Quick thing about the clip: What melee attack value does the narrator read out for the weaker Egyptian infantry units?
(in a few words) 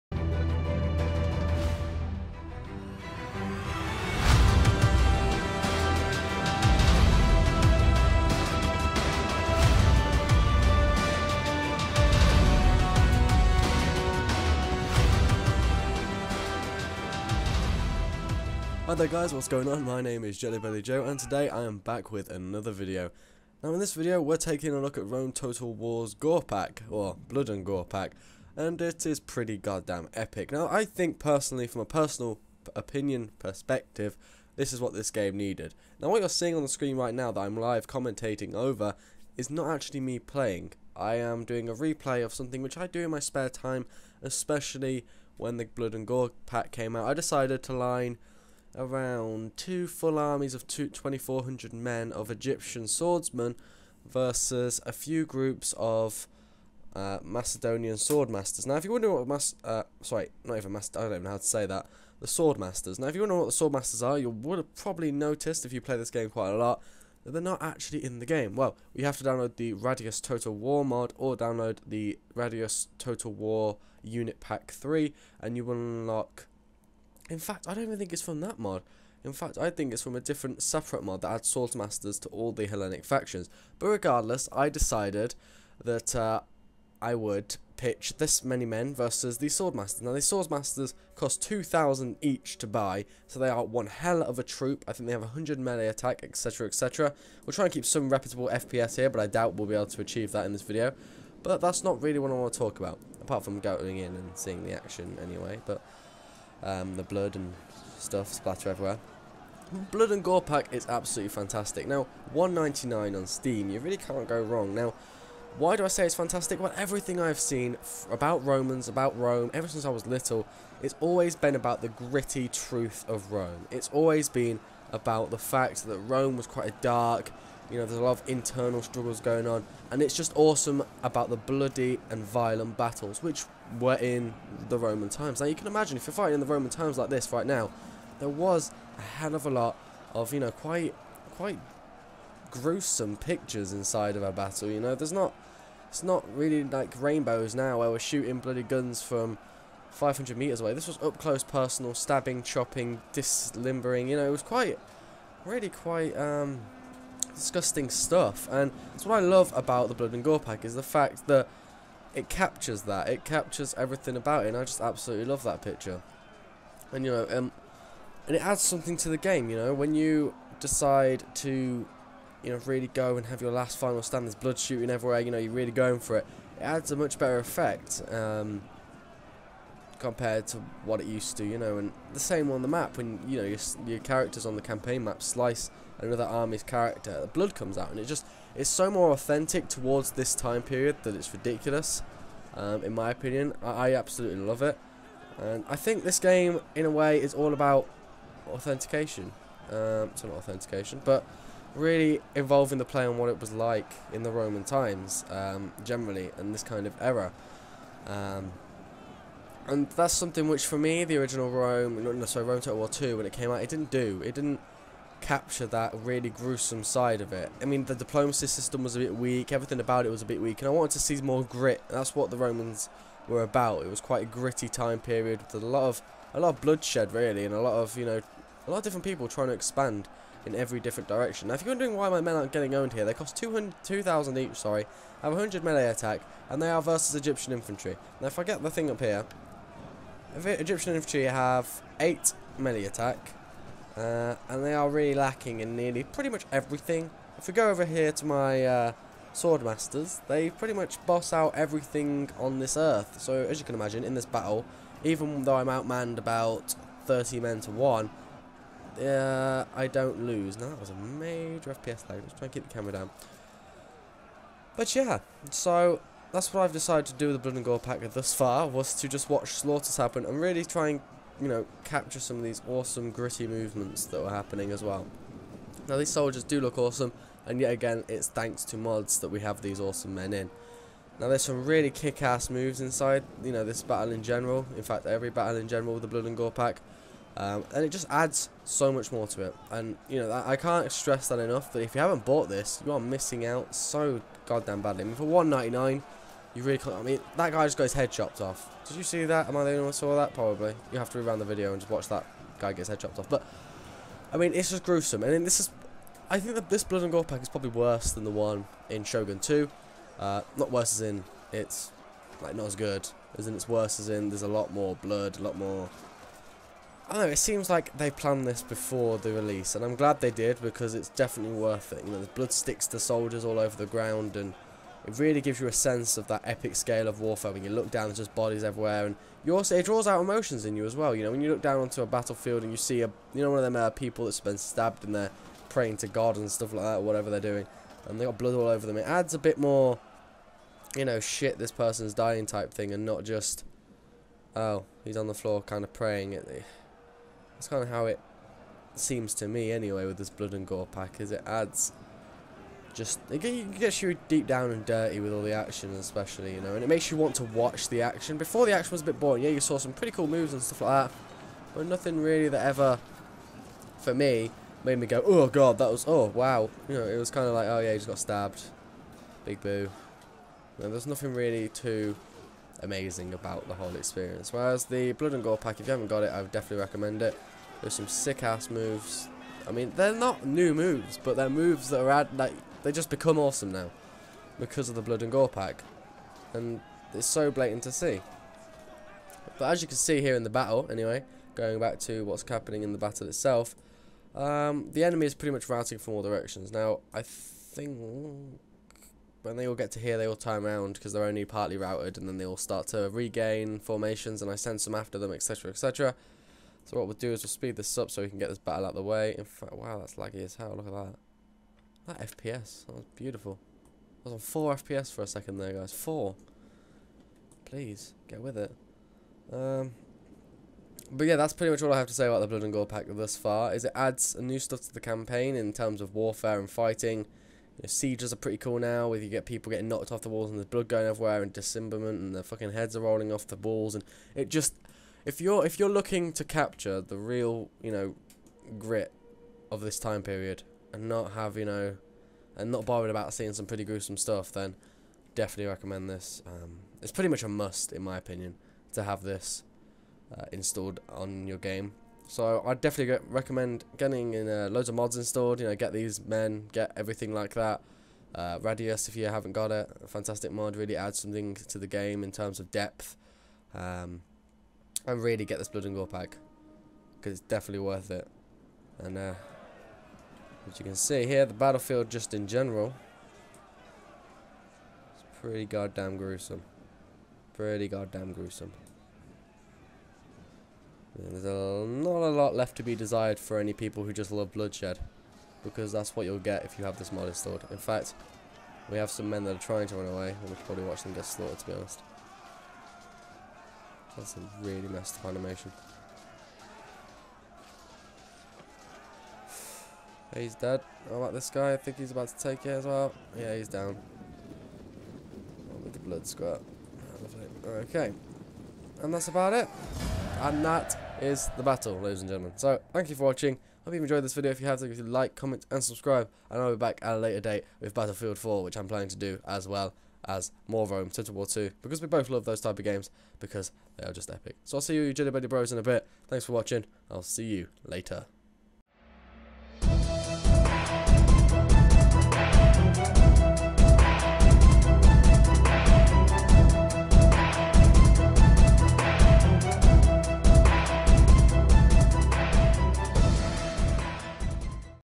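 8.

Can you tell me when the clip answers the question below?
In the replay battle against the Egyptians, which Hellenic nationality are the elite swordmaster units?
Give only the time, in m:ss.
0:57.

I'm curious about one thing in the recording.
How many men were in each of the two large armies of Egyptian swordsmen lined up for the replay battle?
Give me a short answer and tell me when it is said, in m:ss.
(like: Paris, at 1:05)
2,400, at 0:50.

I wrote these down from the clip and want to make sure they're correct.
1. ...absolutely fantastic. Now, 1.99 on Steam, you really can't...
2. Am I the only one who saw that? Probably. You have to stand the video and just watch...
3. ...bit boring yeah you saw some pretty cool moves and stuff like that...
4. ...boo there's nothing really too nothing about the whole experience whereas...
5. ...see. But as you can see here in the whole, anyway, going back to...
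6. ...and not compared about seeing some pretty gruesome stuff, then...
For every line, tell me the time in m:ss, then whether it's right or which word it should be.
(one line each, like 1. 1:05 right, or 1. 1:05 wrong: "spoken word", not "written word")
1. 1:50 right
2. 4:59 wrong: "rewind", not "stand"
3. 5:59 right
4. 6:09 wrong: "amazing", not "nothing"
5. 6:27 wrong: "battle", not "whole"
6. 7:22 wrong: "bothered", not "compared".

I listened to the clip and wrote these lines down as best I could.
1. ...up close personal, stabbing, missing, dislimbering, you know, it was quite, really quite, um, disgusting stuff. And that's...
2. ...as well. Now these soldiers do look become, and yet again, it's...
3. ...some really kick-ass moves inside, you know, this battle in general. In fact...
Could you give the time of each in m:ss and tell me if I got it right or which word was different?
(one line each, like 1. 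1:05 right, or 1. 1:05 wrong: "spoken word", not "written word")
1. 2:31 wrong: "chopping", not "missing"
2. 4:34 wrong: "awesome", not "become"
3. 4:41 right.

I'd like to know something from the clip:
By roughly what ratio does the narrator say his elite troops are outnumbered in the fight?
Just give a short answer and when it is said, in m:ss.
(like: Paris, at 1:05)
30 to 1, at 4:17.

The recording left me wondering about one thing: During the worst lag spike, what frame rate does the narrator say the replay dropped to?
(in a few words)
4 FPS.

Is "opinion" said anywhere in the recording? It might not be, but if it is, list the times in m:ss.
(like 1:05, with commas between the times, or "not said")
0:32, 3:13, 7:28.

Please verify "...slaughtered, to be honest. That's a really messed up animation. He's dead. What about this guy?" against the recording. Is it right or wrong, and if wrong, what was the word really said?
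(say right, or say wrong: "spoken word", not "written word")
right.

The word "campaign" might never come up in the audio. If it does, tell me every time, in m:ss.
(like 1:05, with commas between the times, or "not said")
3:04, 7:04.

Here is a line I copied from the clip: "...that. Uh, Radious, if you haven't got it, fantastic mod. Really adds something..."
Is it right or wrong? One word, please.
right.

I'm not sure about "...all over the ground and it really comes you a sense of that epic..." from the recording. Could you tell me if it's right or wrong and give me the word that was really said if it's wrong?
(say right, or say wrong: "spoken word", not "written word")
wrong: "gives", not "comes".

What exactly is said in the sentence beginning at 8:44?
So I'll see you, you buddy Bros, in a bit.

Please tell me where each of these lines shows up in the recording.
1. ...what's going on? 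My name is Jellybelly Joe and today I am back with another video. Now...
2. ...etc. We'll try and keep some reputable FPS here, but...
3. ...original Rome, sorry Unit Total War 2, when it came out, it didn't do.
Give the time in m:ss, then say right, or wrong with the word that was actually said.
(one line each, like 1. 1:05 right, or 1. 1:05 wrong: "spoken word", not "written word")
1. 0:19 right
2. 1:36 right
3. 3:31 wrong: "Rome", not "Unit".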